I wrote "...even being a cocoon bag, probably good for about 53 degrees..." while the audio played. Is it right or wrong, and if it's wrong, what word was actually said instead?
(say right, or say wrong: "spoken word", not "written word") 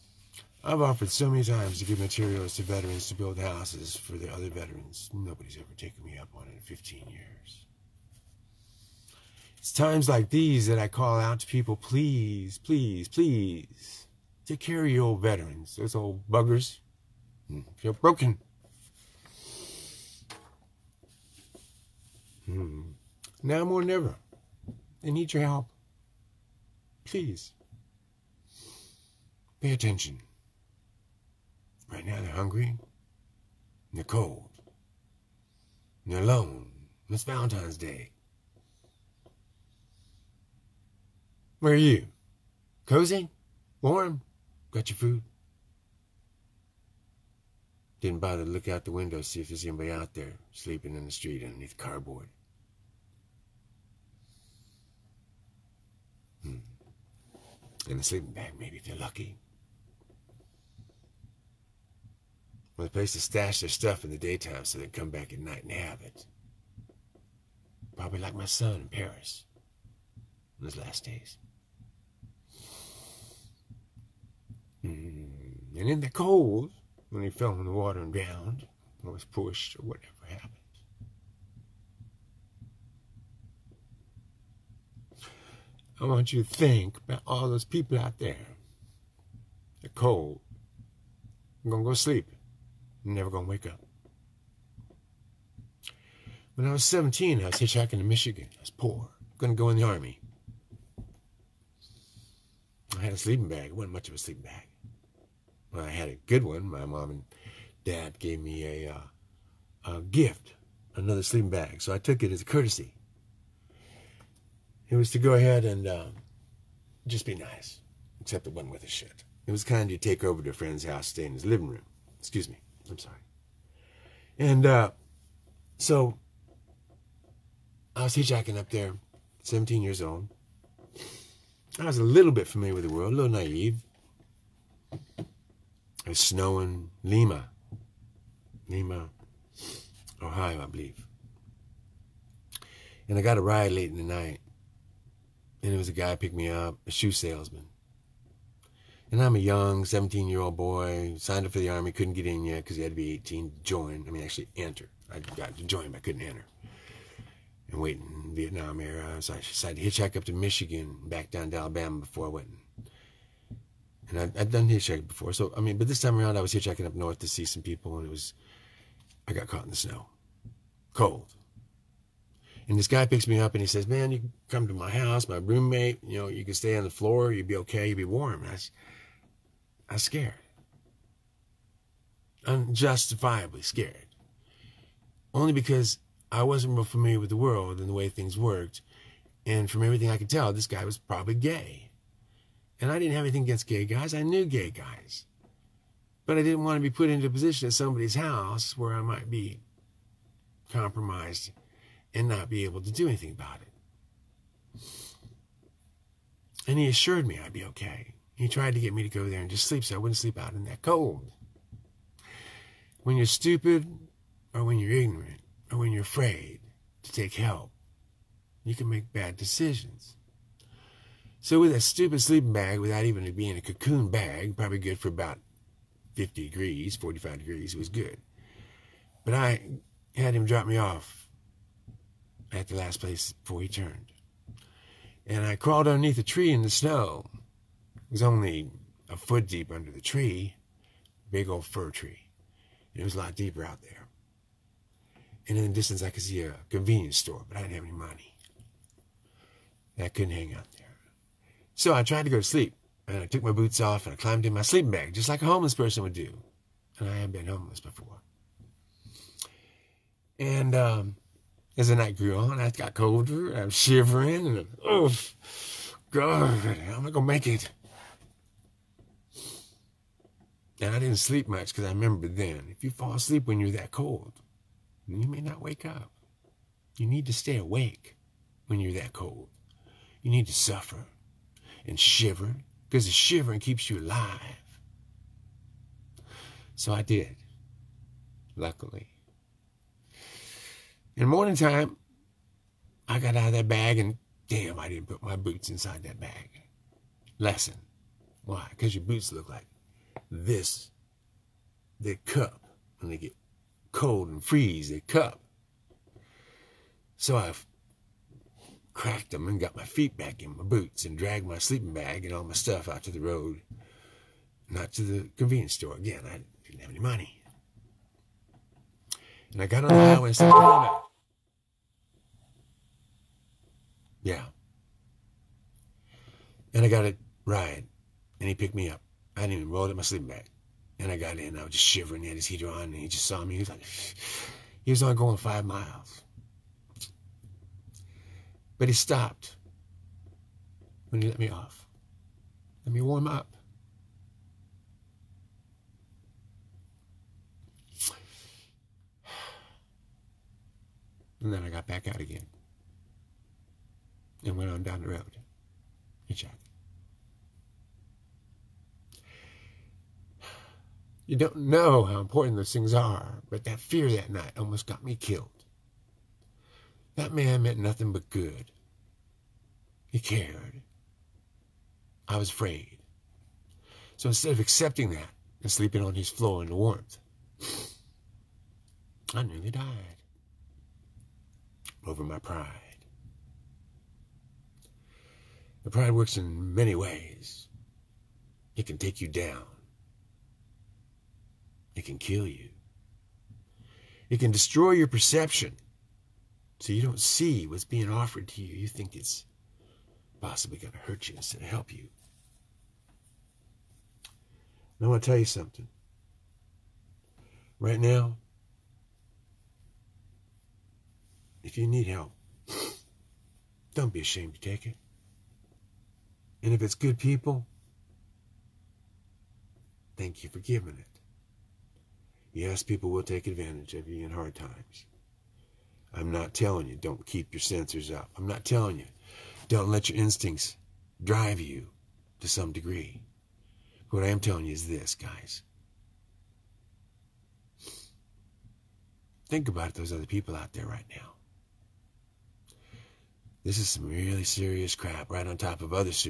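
wrong: "50", not "53".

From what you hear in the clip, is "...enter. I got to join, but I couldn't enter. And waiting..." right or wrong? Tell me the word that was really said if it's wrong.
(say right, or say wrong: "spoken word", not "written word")
right.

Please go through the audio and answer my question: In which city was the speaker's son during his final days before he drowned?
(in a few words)
Paris.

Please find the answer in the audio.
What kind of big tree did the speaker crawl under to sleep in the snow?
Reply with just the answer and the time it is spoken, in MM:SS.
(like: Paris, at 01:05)
Fir tree, at 04:01.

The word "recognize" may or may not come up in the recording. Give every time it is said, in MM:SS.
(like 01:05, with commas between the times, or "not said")
not said.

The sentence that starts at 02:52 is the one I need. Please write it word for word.
And this guy picks me up and he says, "Man, you come to my house, my roommate.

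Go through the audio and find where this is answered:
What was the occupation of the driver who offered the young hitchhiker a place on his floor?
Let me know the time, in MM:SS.
02:26.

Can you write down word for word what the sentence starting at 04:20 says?
And um, as the night grew on, I got colder.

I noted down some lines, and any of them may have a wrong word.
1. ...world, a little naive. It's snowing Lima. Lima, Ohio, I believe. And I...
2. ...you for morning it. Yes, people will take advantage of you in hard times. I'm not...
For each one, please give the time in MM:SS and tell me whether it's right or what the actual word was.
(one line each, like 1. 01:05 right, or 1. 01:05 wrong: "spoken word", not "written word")
1. 02:12 right
2. 07:00 wrong: "giving", not "morning".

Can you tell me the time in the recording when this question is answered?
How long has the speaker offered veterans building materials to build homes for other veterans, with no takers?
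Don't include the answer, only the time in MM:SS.
00:06.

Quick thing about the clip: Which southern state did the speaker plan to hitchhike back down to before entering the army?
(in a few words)
Alabama.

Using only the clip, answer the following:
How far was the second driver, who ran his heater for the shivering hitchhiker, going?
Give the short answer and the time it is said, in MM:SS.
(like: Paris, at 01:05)
5 miles, at 05:35.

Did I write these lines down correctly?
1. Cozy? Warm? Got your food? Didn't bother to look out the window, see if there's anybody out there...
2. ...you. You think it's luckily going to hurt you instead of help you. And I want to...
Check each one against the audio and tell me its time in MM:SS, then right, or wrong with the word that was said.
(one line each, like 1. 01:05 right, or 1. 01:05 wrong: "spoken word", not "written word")
1. 00:42 right
2. 06:38 wrong: "possibly", not "luckily".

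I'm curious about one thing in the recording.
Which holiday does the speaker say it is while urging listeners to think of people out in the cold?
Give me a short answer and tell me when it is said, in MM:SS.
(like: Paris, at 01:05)
Valentine's Day, at 00:37.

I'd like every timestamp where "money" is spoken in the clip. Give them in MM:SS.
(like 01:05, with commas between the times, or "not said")
04:07, 05:16.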